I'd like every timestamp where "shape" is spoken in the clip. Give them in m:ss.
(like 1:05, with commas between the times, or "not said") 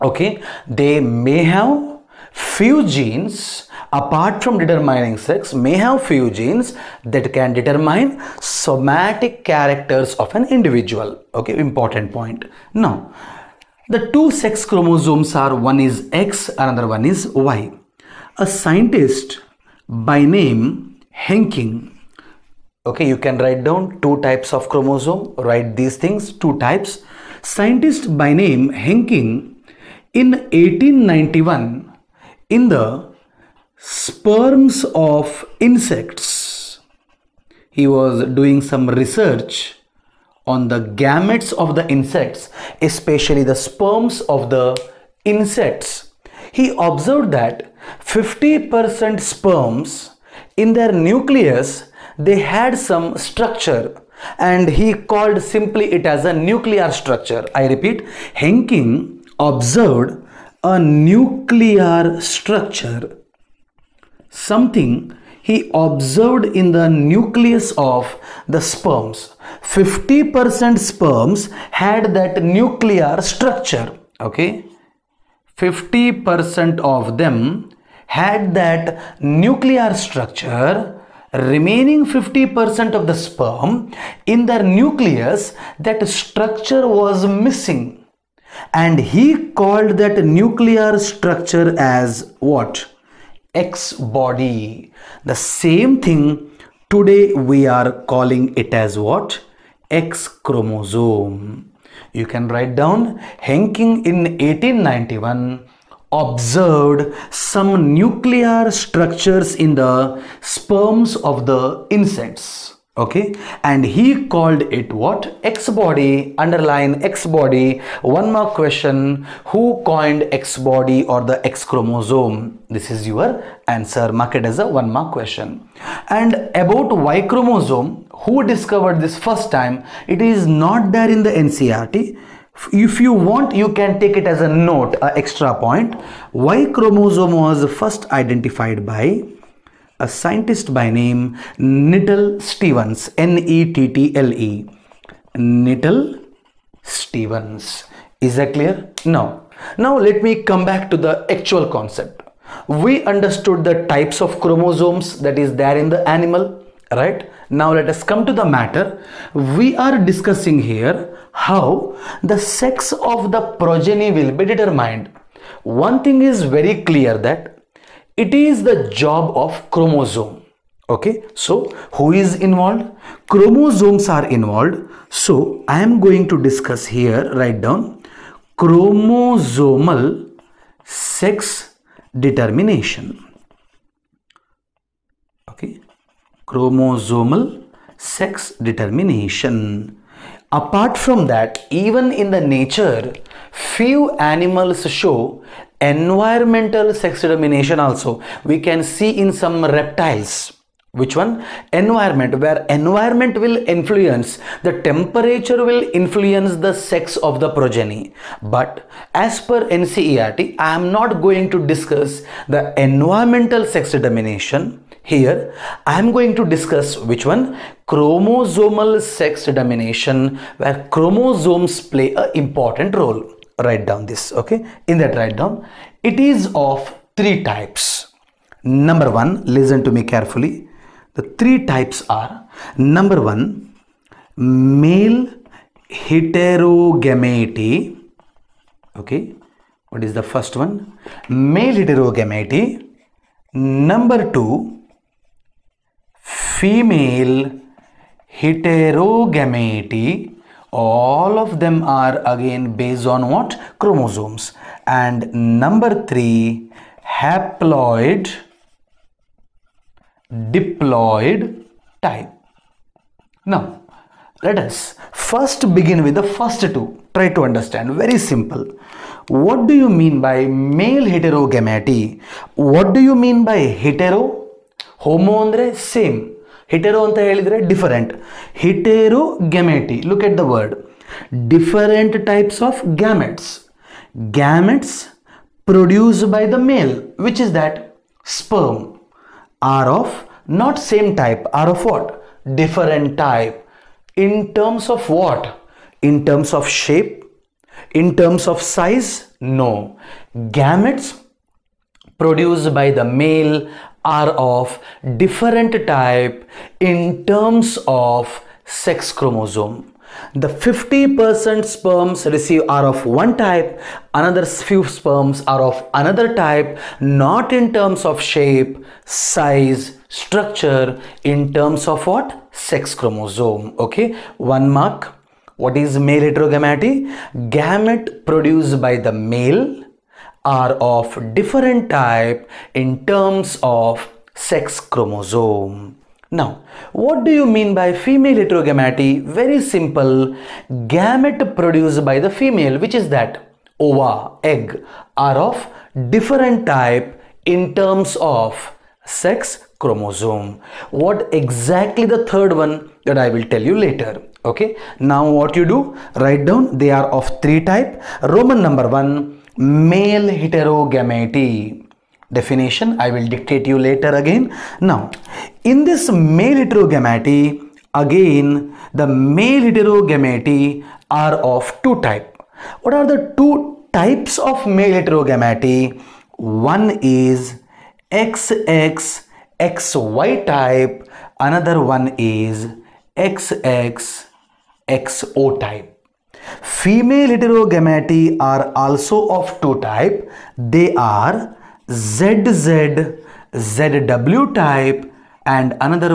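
4:56, 5:18.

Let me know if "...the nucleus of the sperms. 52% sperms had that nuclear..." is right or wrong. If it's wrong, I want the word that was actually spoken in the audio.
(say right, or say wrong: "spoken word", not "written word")
wrong: "50", not "52".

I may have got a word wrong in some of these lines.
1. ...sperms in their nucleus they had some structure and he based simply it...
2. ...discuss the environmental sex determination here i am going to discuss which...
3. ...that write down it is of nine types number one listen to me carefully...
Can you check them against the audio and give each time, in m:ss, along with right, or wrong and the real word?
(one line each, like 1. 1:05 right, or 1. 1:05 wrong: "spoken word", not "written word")
1. 0:49 wrong: "called", not "based"
2. 3:31 right
3. 3:45 wrong: "three", not "nine".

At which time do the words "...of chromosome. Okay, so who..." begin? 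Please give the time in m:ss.
2:49.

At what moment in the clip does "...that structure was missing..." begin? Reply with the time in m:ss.
1:25.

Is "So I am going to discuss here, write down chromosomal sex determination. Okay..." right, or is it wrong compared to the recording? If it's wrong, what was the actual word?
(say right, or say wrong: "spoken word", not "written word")
right.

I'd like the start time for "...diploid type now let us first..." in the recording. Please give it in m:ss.
4:20.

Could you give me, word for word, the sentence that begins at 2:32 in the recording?
We understood the types of chromosomes that is there in the animal, right?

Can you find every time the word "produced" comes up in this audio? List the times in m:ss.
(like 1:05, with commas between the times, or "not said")
4:45, 5:02, 5:28, 5:41.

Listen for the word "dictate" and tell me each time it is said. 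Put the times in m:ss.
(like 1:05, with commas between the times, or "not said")
6:03.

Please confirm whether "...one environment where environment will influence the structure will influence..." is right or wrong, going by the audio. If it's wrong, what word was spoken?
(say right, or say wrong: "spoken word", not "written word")
wrong: "temperature", not "structure".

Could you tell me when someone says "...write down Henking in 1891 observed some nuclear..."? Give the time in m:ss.
1:42.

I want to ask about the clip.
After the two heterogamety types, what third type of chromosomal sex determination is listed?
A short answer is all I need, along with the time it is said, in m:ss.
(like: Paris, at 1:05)
Haploid diploid type, at 4:17.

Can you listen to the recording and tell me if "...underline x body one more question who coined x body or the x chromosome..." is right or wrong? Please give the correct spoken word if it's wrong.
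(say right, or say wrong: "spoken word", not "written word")
right.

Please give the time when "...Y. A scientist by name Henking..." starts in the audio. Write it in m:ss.
0:17.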